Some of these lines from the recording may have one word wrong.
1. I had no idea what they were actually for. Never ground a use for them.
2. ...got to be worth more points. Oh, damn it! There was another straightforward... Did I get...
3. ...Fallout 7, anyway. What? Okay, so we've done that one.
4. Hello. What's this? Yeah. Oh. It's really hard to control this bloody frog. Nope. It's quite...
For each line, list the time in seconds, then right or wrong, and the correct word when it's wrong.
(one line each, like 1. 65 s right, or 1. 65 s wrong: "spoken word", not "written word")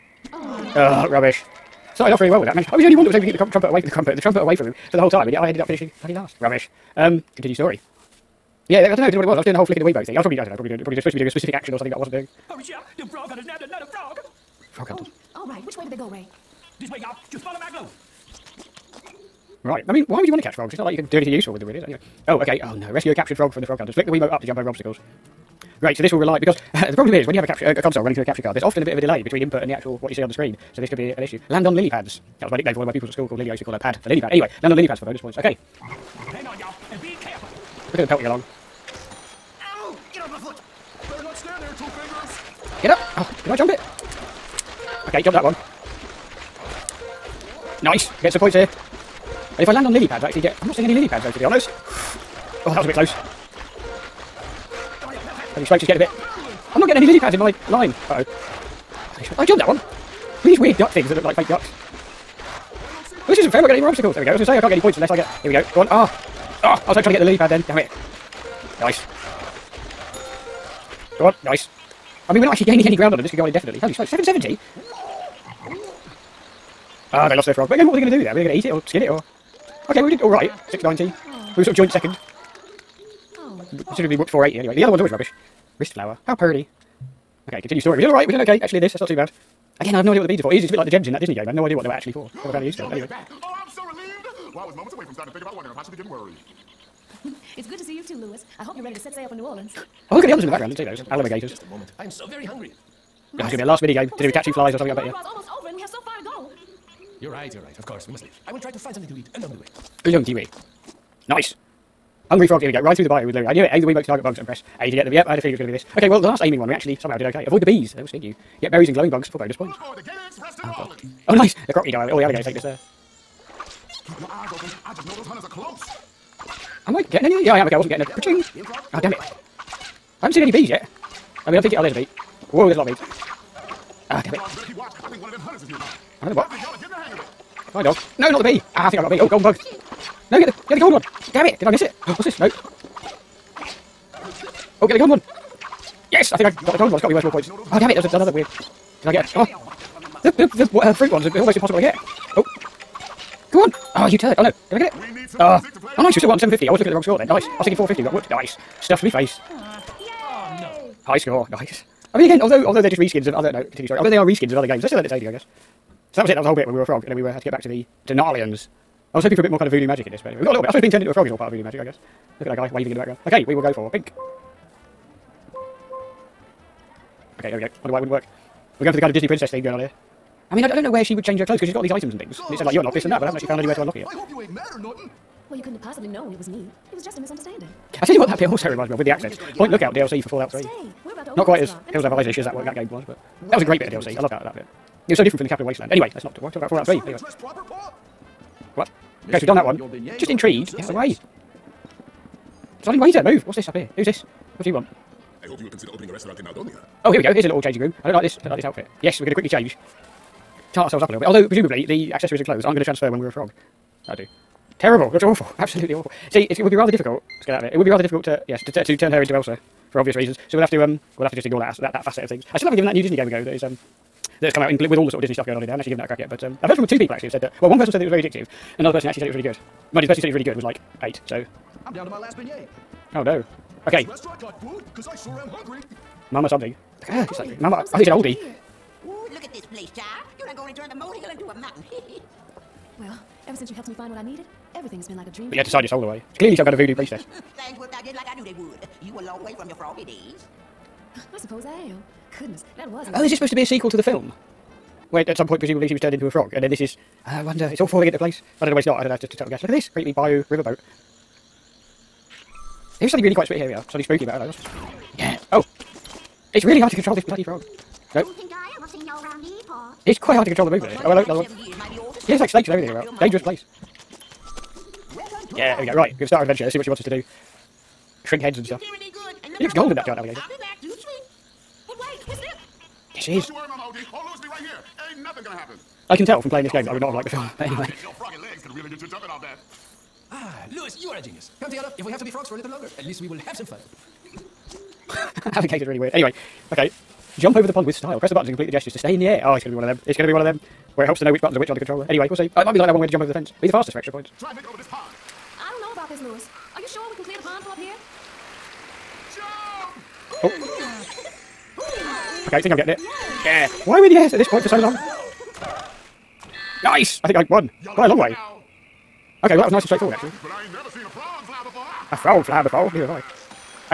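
1. 91 s wrong: "found", not "ground"
2. 147 s wrong: "weird", not "straightforward"
3. 196 s wrong: "3", not "7"
4. 264 s right.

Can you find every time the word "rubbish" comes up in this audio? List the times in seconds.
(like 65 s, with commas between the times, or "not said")
1 s, 6 s, 85 s.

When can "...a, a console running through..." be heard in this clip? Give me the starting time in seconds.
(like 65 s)
27 s.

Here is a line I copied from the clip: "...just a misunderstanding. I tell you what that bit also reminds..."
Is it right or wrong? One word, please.
right.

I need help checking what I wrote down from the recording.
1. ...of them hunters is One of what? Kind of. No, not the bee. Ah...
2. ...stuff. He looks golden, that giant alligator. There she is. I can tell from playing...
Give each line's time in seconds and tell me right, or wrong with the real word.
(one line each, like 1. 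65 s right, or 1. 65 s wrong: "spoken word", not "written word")
1. 135 s right
2. 278 s right.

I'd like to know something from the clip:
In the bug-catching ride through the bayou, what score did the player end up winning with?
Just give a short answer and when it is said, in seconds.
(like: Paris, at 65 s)
750, at 156 s.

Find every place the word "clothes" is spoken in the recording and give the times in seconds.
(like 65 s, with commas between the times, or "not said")
181 s, 212 s.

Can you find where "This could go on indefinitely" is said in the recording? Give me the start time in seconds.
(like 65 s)
73 s.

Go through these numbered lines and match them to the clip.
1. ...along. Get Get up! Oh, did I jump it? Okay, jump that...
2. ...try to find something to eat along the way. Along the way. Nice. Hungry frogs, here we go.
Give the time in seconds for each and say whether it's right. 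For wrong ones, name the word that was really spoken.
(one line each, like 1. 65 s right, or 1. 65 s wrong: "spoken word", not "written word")
1. 38 s right
2. 108 s right.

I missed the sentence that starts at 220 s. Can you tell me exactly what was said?
So we'll have to um we'll have to just ignore that that that facet of things.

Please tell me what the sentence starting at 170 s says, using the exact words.
I suppose being turned into a frog is all part of voodoo magic, I guess.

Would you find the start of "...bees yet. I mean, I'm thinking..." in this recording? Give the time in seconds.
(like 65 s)
130 s.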